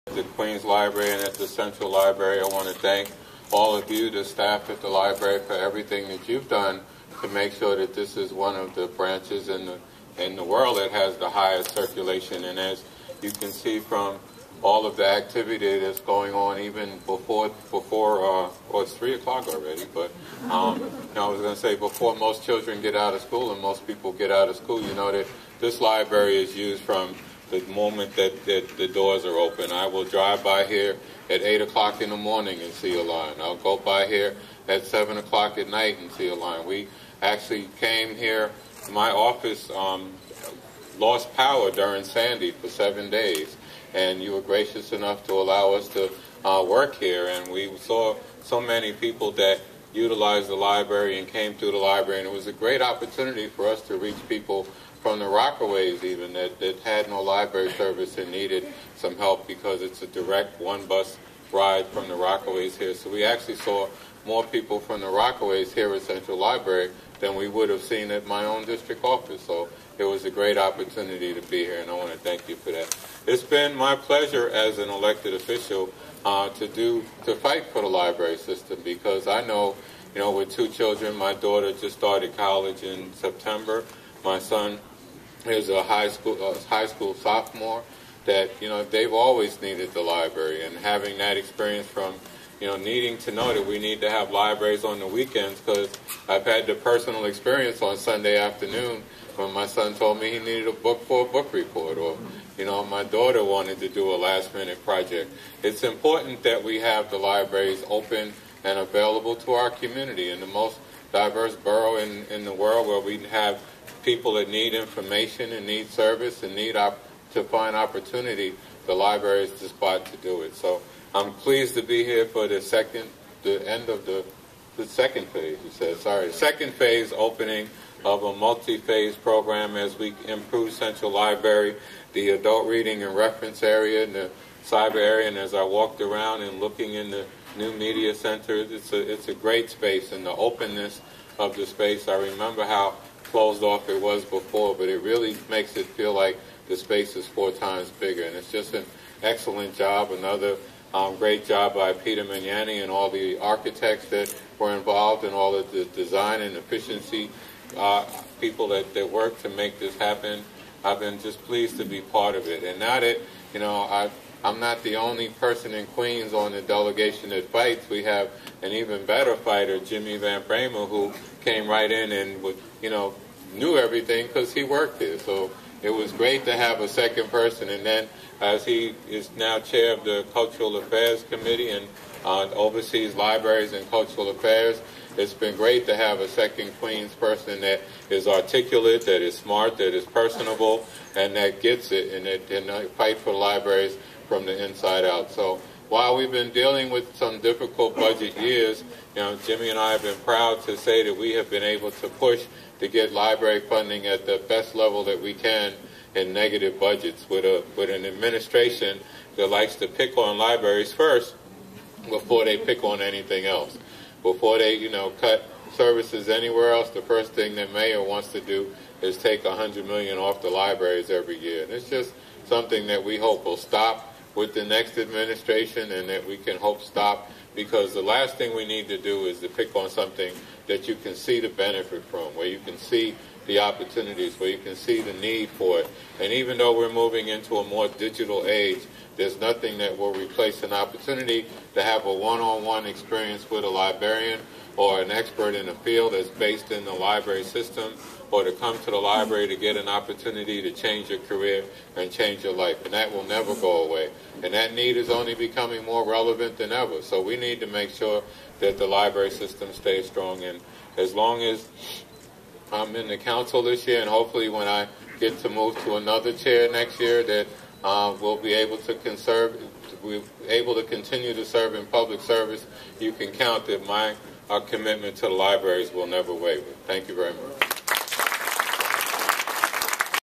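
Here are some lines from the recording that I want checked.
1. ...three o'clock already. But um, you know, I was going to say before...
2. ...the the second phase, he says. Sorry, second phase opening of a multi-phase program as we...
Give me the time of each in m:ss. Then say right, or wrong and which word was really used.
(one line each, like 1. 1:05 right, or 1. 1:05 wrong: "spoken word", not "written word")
1. 0:18 right
2. 2:04 right.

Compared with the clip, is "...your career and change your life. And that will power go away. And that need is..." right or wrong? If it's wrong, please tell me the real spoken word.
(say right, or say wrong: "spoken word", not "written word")
wrong: "never", not "power".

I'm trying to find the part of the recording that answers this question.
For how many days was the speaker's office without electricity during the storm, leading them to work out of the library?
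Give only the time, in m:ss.
0:42.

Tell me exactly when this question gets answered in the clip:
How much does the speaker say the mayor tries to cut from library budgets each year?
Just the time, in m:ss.
3:39.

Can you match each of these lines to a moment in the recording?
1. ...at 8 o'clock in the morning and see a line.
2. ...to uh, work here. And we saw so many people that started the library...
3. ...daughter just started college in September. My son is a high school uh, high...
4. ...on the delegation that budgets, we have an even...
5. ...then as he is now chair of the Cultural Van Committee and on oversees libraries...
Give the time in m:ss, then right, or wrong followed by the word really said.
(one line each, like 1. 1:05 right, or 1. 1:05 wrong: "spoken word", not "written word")
1. 0:31 right
2. 0:45 wrong: "utilized", not "started"
3. 1:21 right
4. 2:46 wrong: "fights", not "budgets"
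5. 2:57 wrong: "Affairs", not "Van".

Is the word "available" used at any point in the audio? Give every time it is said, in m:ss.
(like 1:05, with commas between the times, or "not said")
1:48.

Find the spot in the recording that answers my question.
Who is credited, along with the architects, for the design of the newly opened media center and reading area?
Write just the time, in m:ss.
2:31.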